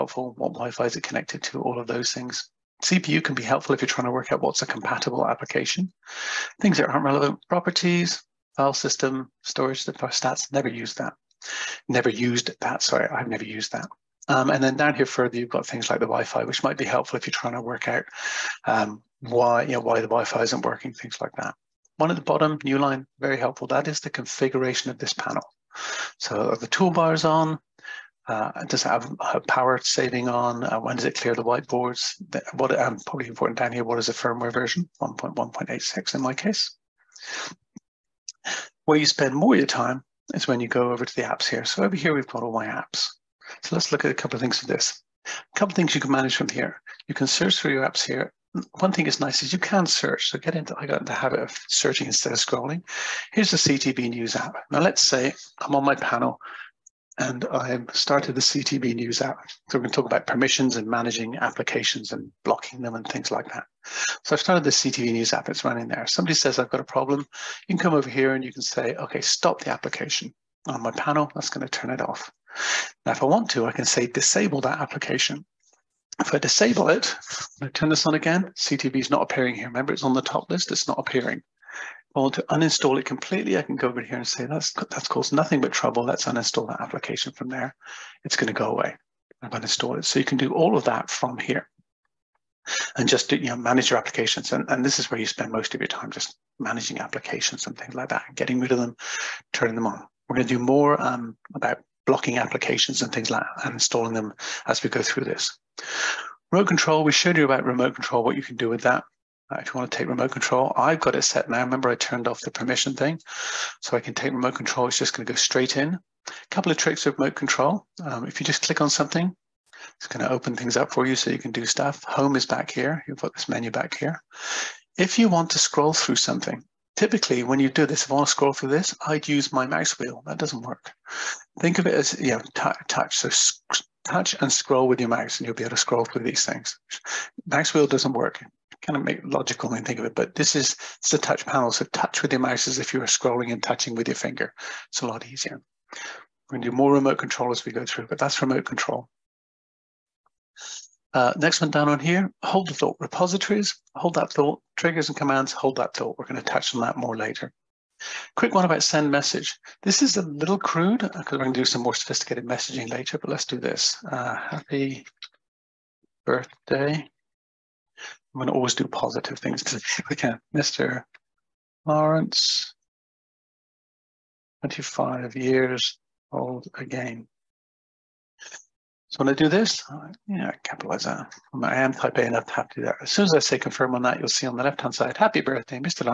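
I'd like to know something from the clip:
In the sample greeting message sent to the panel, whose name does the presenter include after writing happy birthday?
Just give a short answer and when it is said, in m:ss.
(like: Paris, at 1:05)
Mr. Lawrence, at 2:50.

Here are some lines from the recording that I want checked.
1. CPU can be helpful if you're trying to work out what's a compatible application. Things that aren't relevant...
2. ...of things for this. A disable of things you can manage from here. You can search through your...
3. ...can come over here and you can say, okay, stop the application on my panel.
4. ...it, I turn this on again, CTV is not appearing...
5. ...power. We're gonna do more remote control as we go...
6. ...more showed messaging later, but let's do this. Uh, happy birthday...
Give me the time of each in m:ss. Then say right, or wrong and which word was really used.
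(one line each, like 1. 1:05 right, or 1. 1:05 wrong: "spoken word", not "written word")
1. 0:02 right
2. 0:44 wrong: "couple", not "disable"
3. 1:07 right
4. 1:16 right
5. 2:25 wrong: "easier", not "power"
6. 2:41 wrong: "sophisticated", not "showed".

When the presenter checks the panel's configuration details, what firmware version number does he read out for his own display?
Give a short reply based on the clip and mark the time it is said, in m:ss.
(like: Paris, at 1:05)
1.1.86, at 0:35.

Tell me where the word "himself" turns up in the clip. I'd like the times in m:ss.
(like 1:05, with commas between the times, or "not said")
not said.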